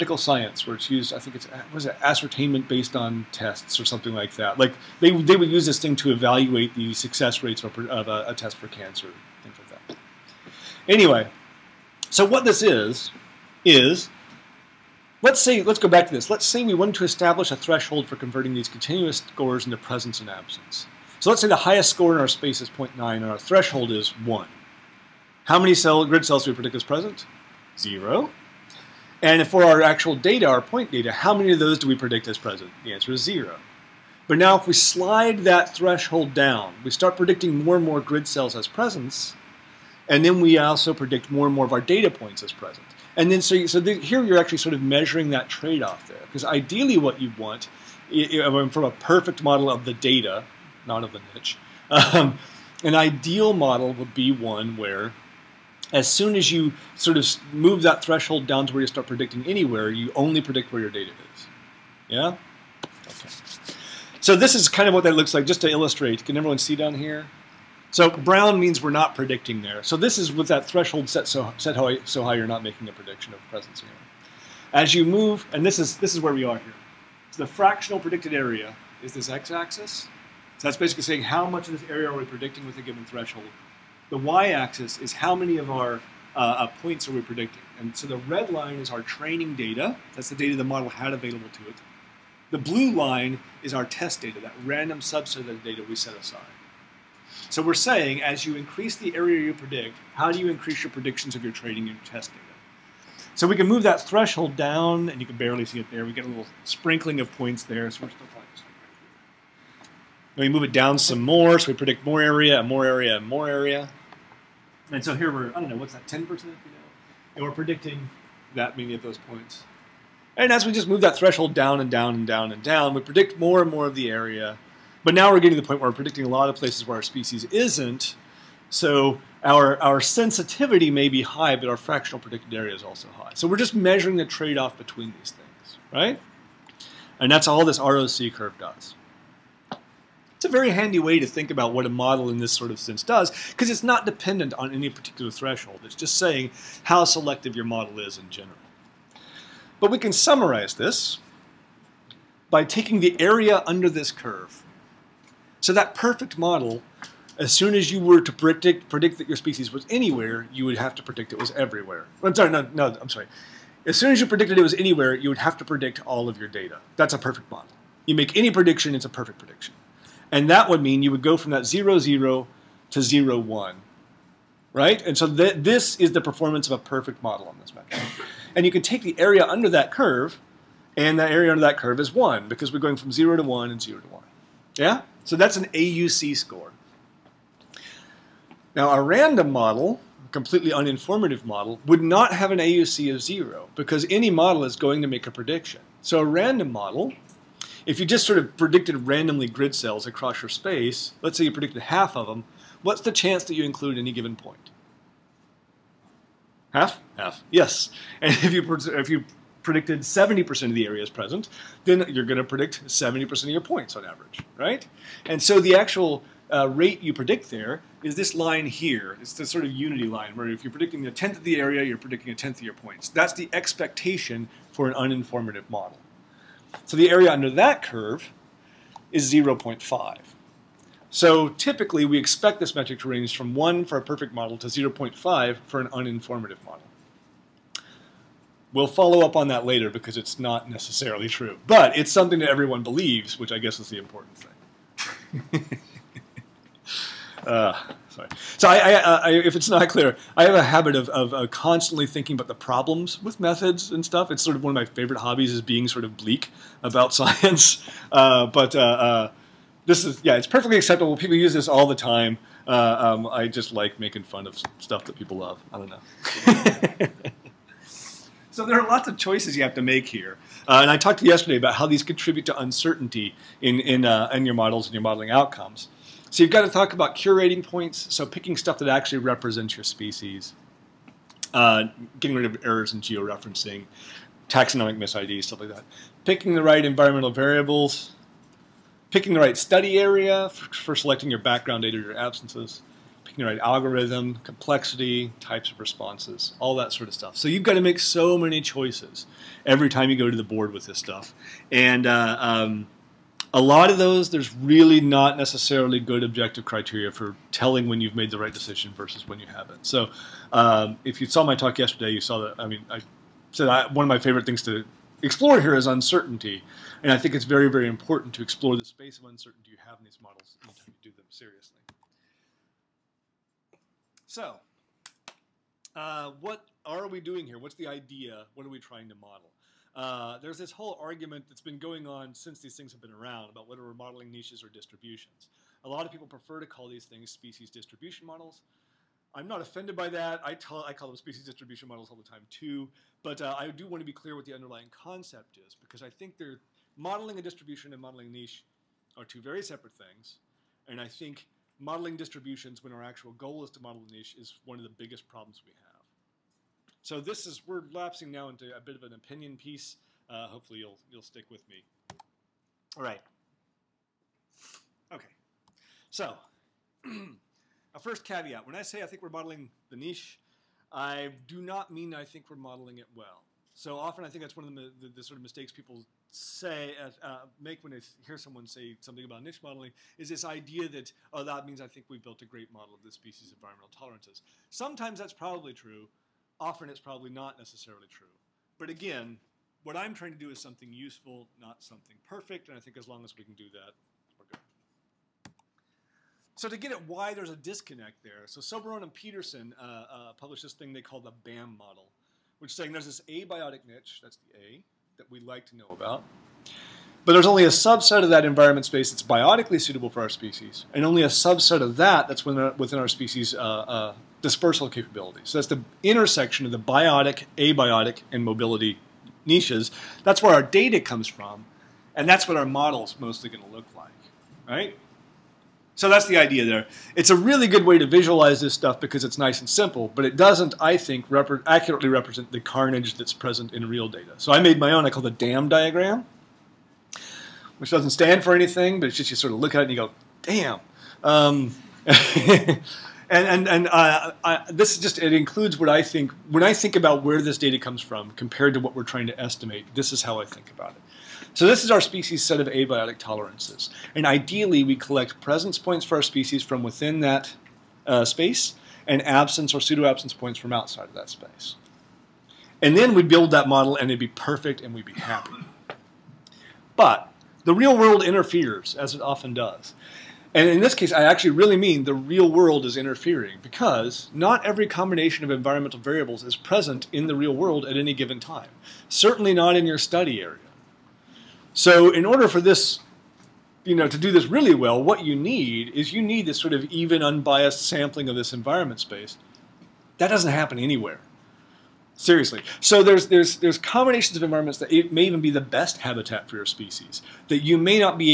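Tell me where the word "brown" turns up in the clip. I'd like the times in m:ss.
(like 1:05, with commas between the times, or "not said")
1:08.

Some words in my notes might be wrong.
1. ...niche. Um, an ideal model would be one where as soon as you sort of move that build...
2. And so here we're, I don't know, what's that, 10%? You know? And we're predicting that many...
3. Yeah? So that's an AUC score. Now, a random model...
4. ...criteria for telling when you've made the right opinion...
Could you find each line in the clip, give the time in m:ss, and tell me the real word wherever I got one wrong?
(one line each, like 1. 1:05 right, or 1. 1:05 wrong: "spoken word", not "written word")
1. 0:51 wrong: "threshold", not "build"
2. 1:54 right
3. 3:04 right
4. 5:06 wrong: "decision", not "opinion".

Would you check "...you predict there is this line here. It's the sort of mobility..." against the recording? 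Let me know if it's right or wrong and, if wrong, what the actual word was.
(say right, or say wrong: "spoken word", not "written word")
wrong: "unity", not "mobility".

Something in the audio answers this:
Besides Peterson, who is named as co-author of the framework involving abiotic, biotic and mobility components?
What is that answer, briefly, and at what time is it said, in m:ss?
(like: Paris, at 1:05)
Soberon, at 6:38.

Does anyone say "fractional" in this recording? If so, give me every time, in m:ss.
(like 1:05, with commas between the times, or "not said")
1:17, 2:11.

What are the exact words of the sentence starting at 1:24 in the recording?
The y-axis is how many of our uh, uh, points are we predicting.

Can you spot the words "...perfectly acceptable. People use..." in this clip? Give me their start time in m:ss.
4:20.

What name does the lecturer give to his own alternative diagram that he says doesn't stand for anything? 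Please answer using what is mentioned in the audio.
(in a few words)
DAM diagram.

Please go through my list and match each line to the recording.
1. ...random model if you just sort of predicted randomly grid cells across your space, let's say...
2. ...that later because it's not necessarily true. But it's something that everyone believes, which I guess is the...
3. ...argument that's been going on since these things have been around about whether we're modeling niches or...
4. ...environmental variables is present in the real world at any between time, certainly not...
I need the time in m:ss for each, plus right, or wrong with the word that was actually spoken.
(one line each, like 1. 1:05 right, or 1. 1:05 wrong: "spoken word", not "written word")
1. 3:16 right
2. 3:59 right
3. 5:30 right
4. 7:55 wrong: "given", not "between".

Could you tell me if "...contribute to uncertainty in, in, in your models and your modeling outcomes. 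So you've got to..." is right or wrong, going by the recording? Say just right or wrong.
right.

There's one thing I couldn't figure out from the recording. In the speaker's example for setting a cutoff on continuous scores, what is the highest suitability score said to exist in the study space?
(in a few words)
0.9.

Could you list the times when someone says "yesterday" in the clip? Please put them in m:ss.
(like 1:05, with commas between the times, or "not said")
4:31, 5:11.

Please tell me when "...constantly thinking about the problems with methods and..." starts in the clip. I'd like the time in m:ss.
4:11.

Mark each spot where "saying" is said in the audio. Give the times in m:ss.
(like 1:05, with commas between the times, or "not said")
1:21, 1:37, 2:26, 6:42.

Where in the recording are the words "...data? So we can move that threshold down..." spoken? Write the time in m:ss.
1:42.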